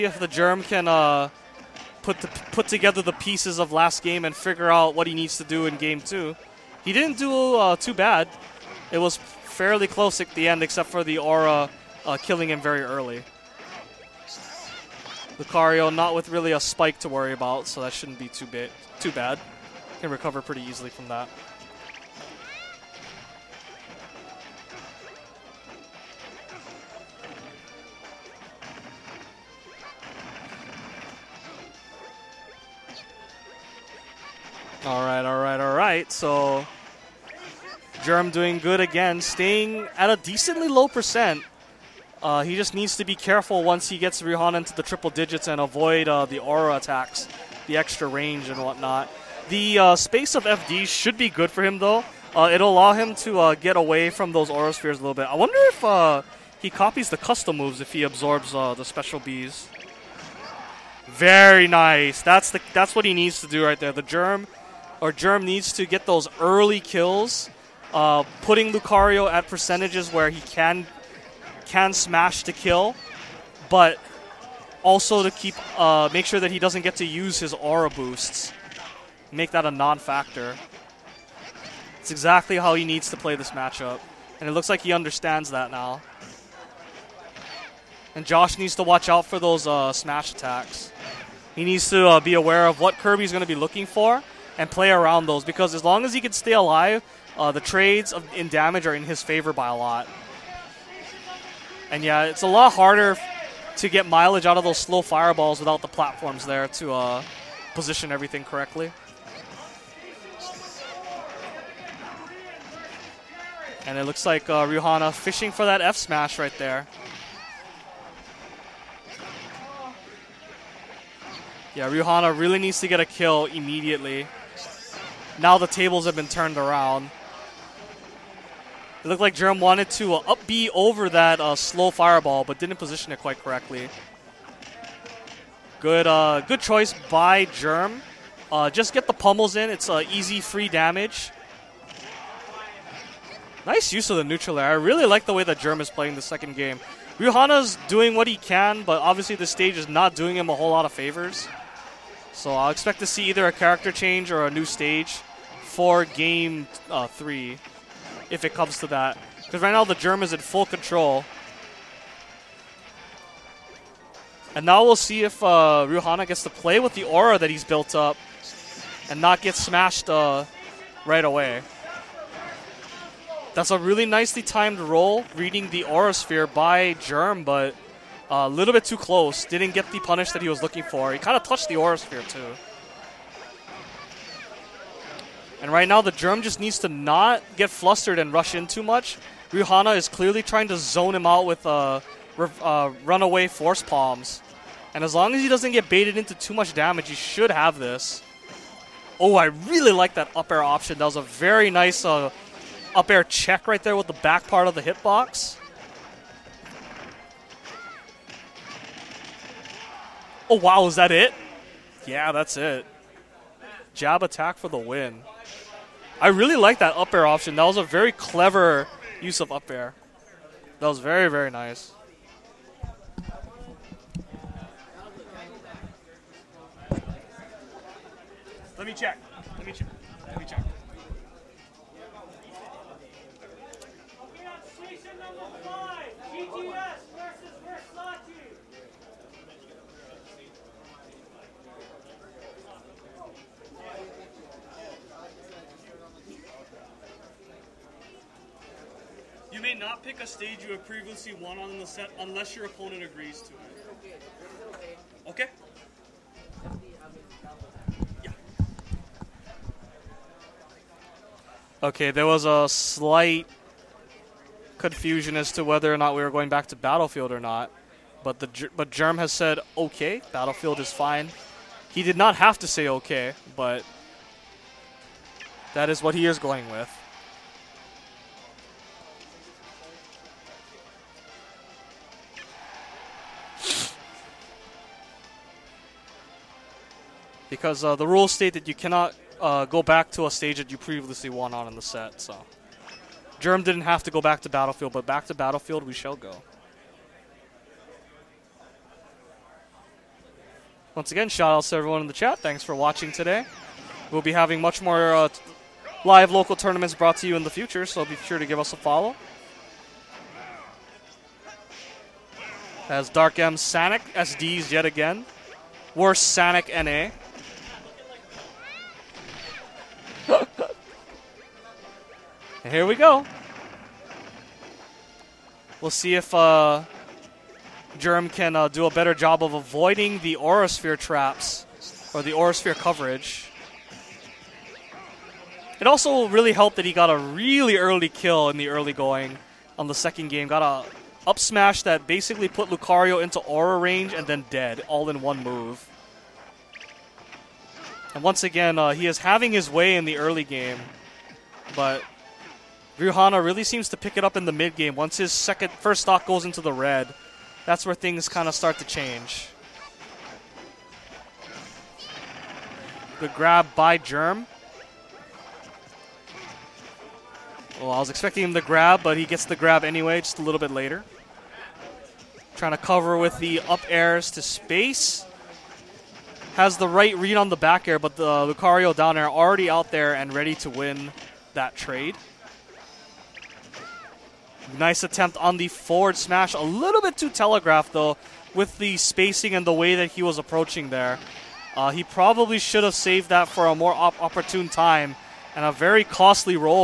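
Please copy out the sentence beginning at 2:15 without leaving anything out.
Good, uh, good choice by Germ.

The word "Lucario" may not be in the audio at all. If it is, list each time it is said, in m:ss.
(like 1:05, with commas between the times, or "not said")
0:15, 1:08, 5:42, 6:18.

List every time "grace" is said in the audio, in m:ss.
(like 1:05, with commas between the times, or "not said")
not said.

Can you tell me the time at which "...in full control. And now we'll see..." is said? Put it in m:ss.
2:40.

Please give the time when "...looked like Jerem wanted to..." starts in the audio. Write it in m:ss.
2:09.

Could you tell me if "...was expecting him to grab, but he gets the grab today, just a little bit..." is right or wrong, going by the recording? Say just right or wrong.
wrong.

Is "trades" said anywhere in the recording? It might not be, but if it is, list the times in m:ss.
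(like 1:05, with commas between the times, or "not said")
1:37, 6:21.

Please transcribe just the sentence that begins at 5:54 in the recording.
Once his second first stock goes into the red, that's where things kind of start to change.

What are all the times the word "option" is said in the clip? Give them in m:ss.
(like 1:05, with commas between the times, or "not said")
3:20, 3:37.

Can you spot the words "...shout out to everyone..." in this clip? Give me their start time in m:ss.
5:01.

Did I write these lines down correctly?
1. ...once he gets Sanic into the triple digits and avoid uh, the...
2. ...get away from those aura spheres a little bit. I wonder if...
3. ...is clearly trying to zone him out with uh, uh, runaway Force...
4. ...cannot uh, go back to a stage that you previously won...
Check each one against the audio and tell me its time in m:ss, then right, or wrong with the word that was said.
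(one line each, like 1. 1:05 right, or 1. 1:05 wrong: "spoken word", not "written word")
1. 0:43 wrong: "Rihanna", not "Sanic"
2. 0:53 right
3. 3:09 right
4. 4:48 right.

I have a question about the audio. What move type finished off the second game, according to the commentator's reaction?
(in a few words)
Jab attack.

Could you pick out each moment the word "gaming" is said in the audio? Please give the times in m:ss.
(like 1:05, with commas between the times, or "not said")
not said.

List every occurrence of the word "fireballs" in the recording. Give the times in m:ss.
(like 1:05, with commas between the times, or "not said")
1:45, 2:11.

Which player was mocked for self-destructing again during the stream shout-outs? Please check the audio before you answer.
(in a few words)
Dark M Sanic.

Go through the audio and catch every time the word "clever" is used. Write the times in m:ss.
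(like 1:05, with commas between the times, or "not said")
3:38.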